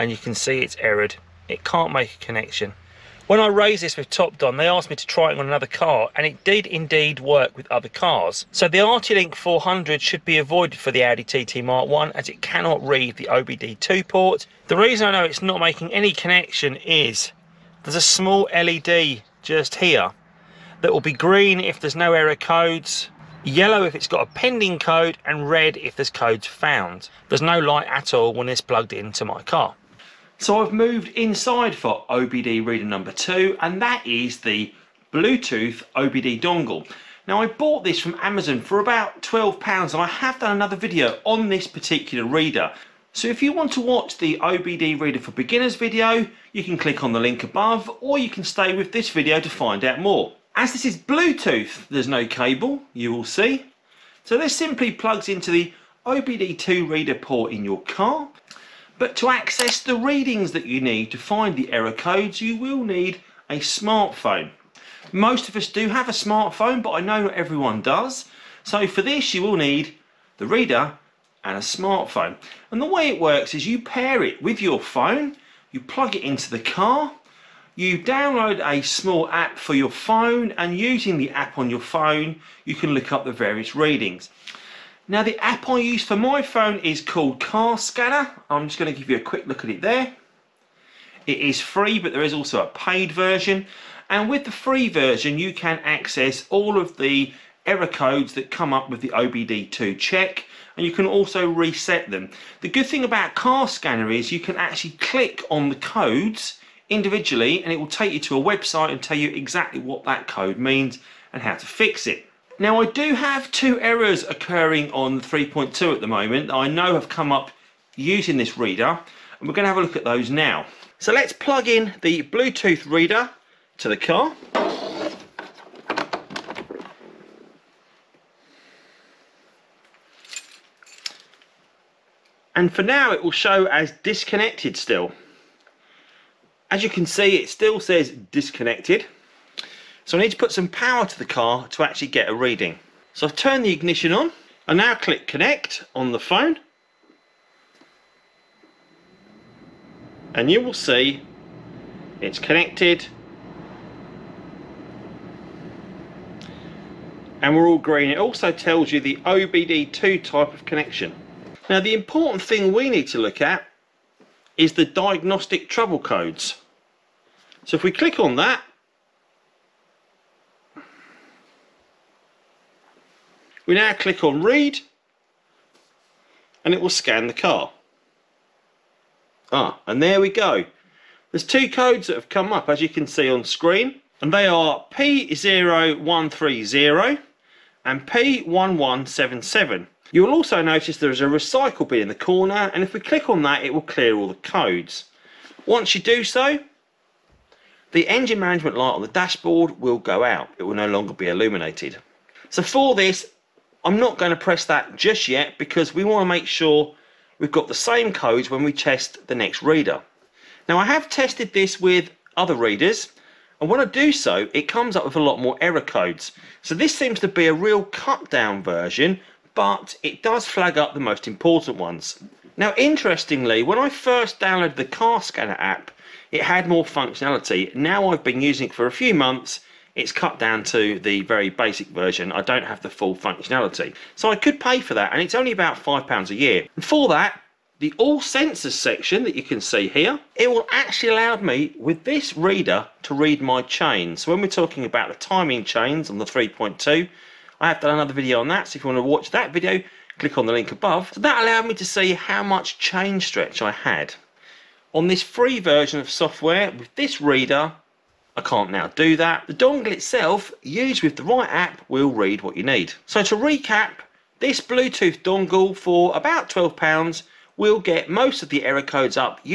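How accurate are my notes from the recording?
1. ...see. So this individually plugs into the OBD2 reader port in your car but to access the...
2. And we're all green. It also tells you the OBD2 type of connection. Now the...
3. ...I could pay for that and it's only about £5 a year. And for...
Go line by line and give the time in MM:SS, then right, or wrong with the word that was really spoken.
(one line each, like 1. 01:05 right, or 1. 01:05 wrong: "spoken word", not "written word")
1. 00:53 wrong: "simply", not "individually"
2. 02:37 right
3. 03:54 right.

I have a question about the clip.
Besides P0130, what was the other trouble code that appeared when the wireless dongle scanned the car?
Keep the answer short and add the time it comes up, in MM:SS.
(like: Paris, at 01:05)
P1177, at 03:08.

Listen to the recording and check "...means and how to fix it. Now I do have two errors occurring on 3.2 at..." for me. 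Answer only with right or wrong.
right.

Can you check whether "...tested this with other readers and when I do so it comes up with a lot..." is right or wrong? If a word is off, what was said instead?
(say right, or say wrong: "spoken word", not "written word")
right.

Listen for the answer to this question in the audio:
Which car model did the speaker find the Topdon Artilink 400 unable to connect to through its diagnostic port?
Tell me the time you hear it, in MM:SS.
00:11.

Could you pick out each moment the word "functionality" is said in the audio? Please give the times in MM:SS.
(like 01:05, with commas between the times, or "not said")
03:46, 03:53.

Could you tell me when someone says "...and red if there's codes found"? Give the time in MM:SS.
00:25.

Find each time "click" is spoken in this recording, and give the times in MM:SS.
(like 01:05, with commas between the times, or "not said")
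00:46, 01:44, 02:24, 02:47, 02:53, 03:12, 04:10.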